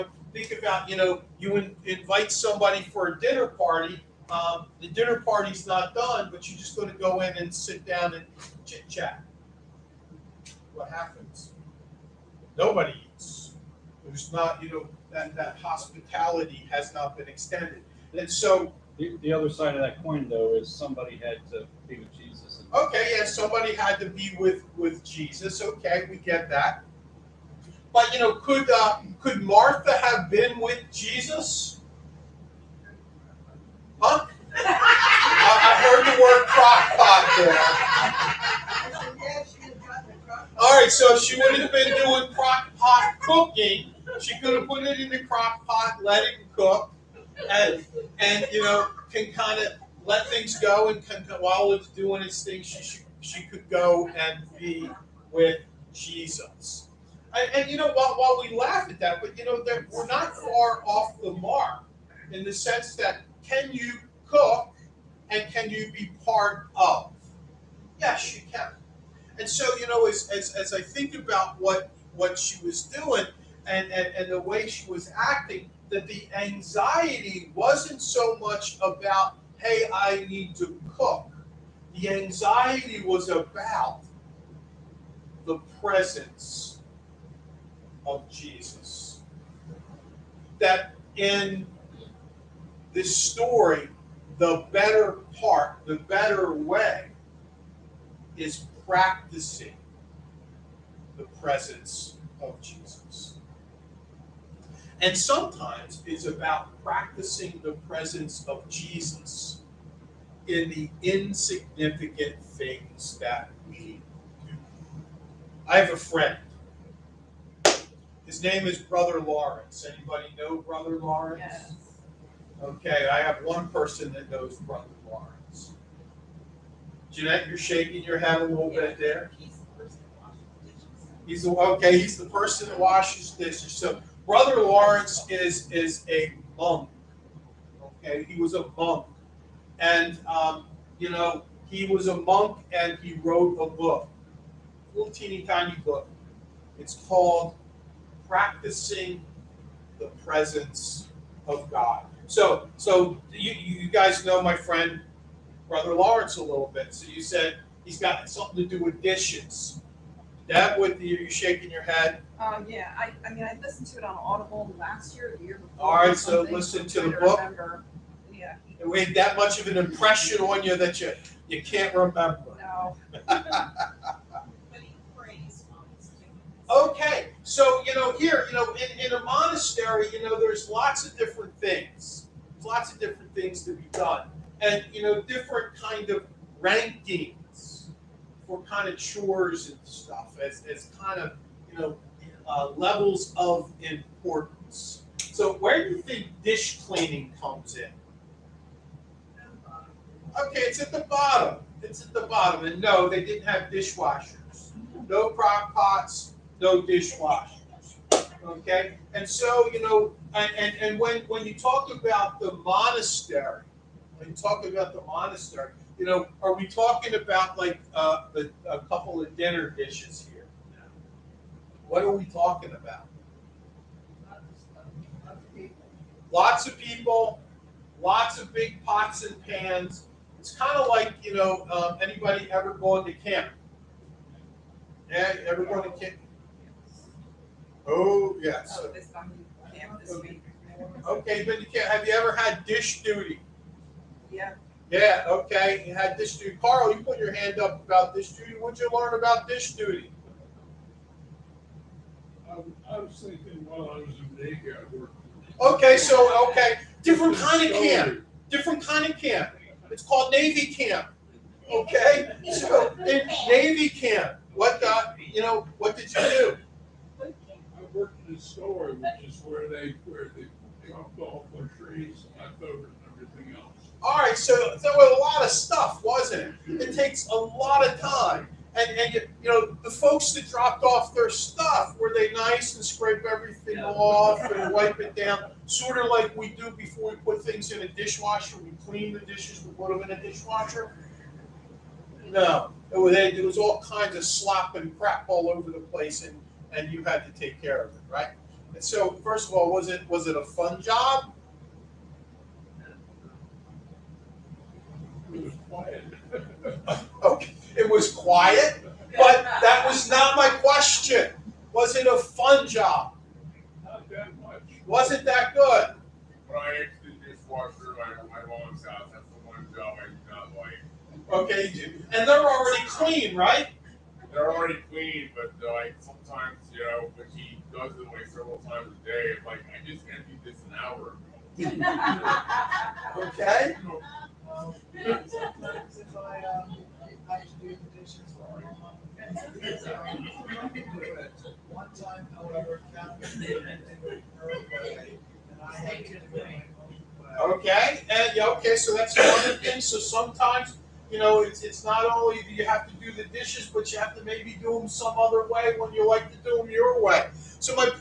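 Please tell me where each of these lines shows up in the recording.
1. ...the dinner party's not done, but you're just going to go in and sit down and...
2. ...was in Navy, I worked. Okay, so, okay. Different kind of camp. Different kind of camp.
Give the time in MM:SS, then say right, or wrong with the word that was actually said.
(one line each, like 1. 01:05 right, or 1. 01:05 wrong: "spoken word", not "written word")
1. 00:04 right
2. 04:13 right.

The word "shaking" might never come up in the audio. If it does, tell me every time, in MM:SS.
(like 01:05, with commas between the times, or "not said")
02:07, 02:41.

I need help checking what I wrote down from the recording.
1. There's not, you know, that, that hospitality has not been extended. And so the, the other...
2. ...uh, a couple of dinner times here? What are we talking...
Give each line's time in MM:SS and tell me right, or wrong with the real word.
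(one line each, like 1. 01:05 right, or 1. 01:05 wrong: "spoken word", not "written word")
1. 00:14 right
2. 03:37 wrong: "dishes", not "times".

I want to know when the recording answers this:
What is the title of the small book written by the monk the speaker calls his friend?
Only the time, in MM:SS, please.
02:28.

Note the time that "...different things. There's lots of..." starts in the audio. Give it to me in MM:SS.
03:01.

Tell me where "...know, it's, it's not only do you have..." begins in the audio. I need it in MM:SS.
05:51.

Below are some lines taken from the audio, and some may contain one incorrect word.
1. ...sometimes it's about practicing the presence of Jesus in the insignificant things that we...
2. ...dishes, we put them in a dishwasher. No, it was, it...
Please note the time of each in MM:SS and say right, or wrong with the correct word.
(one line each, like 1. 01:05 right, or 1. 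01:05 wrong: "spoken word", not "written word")
1. 01:45 right
2. 04:49 right.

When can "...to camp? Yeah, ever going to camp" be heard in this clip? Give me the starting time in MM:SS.
03:53.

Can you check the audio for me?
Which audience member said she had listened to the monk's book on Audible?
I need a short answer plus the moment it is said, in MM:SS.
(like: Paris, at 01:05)
Jeanette, at 02:07.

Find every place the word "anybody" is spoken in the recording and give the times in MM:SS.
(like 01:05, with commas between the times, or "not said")
01:59, 03:52.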